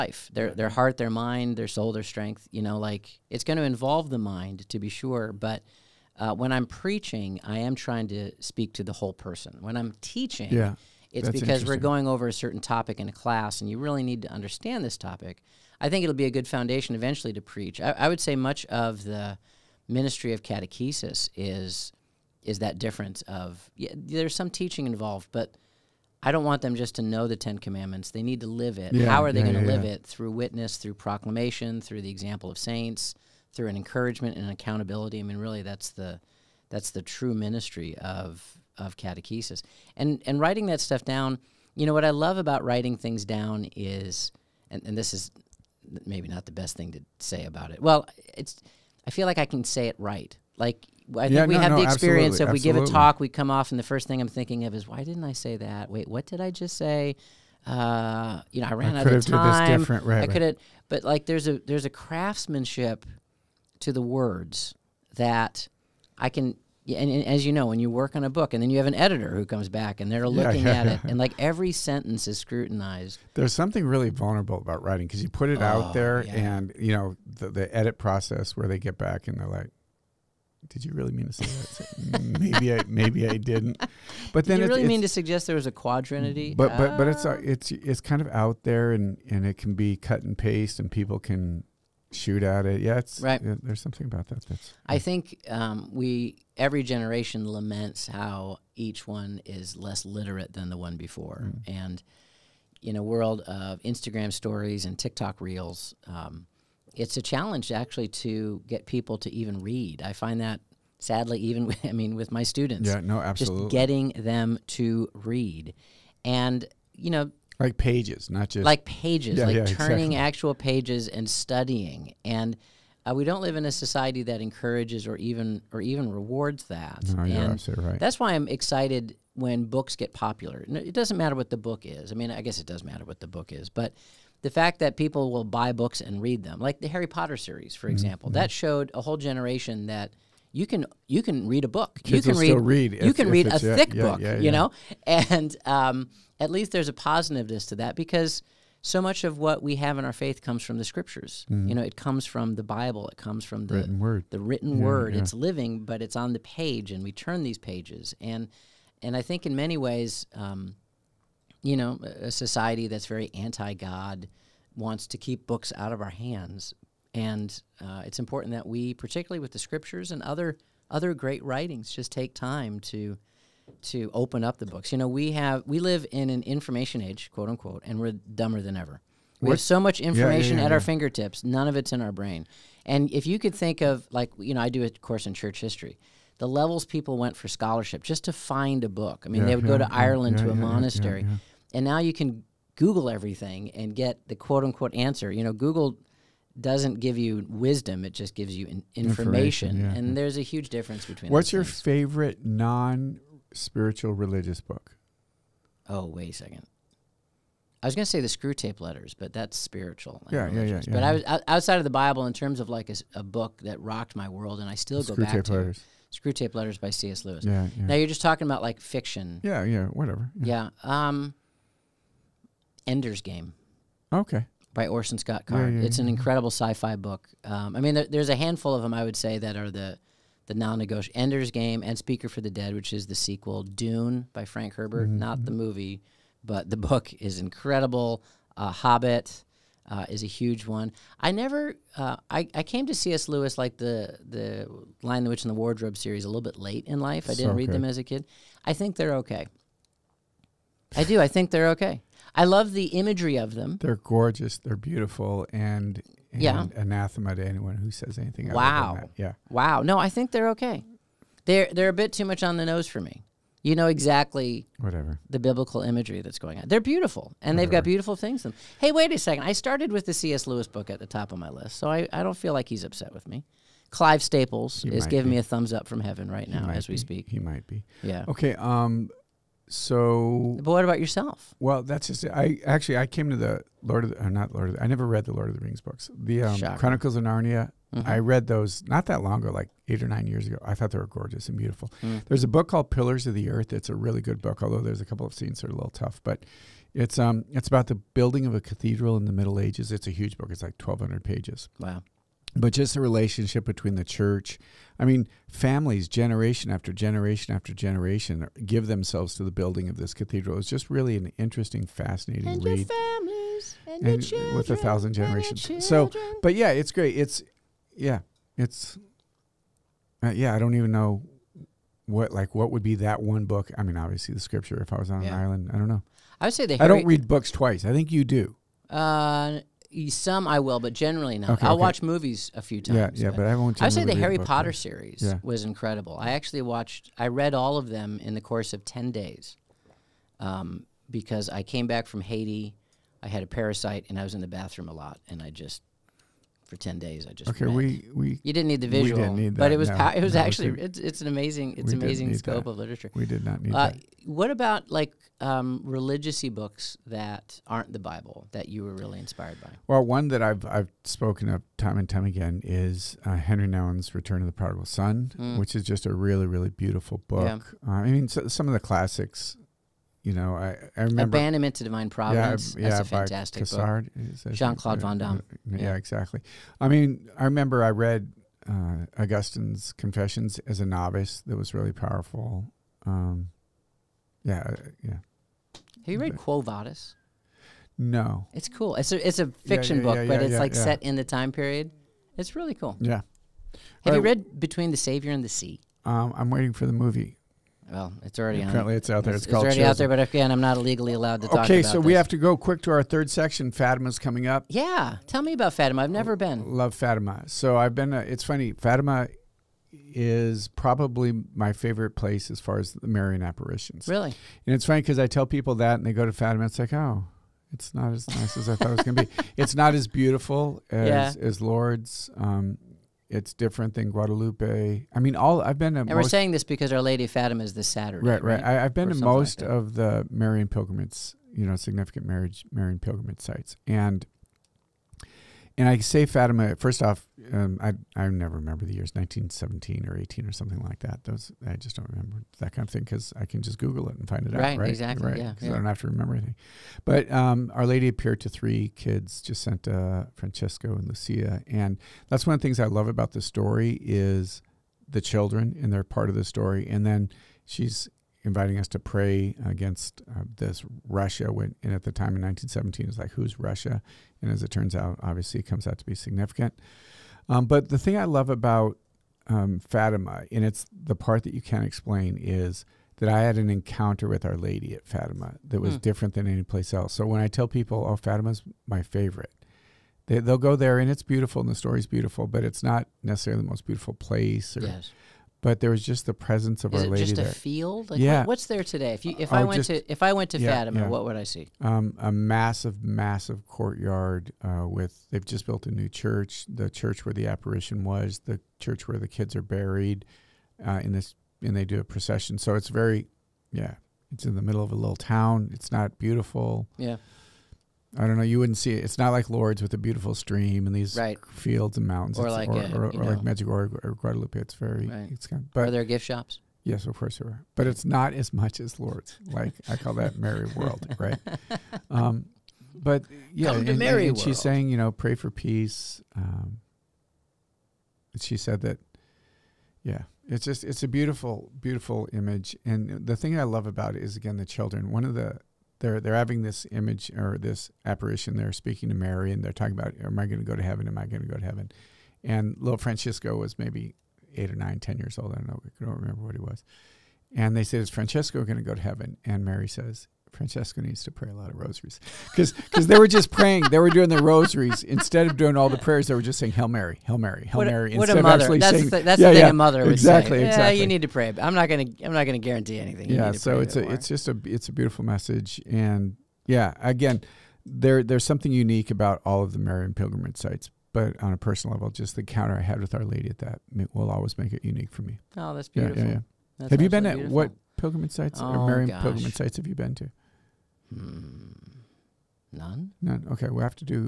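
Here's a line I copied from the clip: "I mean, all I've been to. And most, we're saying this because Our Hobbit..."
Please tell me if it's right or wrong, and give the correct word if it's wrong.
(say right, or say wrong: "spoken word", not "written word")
wrong: "Lady", not "Hobbit".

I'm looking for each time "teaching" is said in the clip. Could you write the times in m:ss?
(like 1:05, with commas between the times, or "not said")
0:10, 0:24.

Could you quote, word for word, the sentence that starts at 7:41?
When, and at the time in 1917, it's like, who's Russia?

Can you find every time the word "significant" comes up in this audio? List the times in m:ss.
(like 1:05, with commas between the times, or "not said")
7:11, 7:46.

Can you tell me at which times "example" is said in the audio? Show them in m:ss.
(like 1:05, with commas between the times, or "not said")
0:32, 2:17.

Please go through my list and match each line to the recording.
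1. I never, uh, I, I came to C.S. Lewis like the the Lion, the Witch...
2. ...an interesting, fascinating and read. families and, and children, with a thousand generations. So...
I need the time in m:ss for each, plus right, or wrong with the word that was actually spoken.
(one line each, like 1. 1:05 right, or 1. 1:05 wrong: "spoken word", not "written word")
1. 4:01 right
2. 5:11 right.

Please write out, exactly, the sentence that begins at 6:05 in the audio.
which is just a really really beautiful book.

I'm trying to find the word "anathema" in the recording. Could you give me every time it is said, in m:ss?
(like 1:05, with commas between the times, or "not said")
4:16.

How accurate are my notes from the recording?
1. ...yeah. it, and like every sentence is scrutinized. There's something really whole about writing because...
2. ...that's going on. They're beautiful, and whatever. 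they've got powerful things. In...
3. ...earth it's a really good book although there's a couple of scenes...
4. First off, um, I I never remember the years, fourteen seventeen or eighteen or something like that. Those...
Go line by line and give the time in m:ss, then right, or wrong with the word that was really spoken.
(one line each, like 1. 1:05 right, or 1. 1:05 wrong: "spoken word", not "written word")
1. 1:10 wrong: "vulnerable", not "whole"
2. 4:26 wrong: "beautiful", not "powerful"
3. 4:53 right
4. 7:16 wrong: "nineteen", not "fourteen".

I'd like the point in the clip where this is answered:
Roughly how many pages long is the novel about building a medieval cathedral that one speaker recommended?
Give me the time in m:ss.
5:00.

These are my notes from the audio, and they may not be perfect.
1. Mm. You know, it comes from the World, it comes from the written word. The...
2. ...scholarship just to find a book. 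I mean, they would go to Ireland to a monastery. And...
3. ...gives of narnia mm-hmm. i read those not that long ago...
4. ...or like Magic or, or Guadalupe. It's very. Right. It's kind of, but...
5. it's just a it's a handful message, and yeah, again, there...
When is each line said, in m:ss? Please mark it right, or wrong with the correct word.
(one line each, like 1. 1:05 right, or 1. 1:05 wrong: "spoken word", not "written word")
1. 2:31 wrong: "Bible", not "World"
2. 3:07 right
3. 4:46 wrong: "chronicles", not "gives"
4. 8:33 right
5. 9:24 wrong: "beautiful", not "handful".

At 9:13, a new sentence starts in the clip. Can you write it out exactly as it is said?
They were doing the rosaries instead of doing all the prayers.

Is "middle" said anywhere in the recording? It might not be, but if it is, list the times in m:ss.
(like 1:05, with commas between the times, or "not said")
4:59, 8:24.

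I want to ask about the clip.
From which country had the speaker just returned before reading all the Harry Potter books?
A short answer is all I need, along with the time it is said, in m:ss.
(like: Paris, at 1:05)
Haiti, at 5:42.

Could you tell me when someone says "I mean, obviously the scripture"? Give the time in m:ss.
5:23.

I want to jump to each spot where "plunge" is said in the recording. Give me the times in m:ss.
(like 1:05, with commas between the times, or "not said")
not said.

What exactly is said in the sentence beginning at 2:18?
that showed a whole generation that you can you can read a book.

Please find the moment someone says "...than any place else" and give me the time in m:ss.
7:56.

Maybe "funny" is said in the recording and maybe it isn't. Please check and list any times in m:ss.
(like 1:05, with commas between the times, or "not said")
6:48, 6:54.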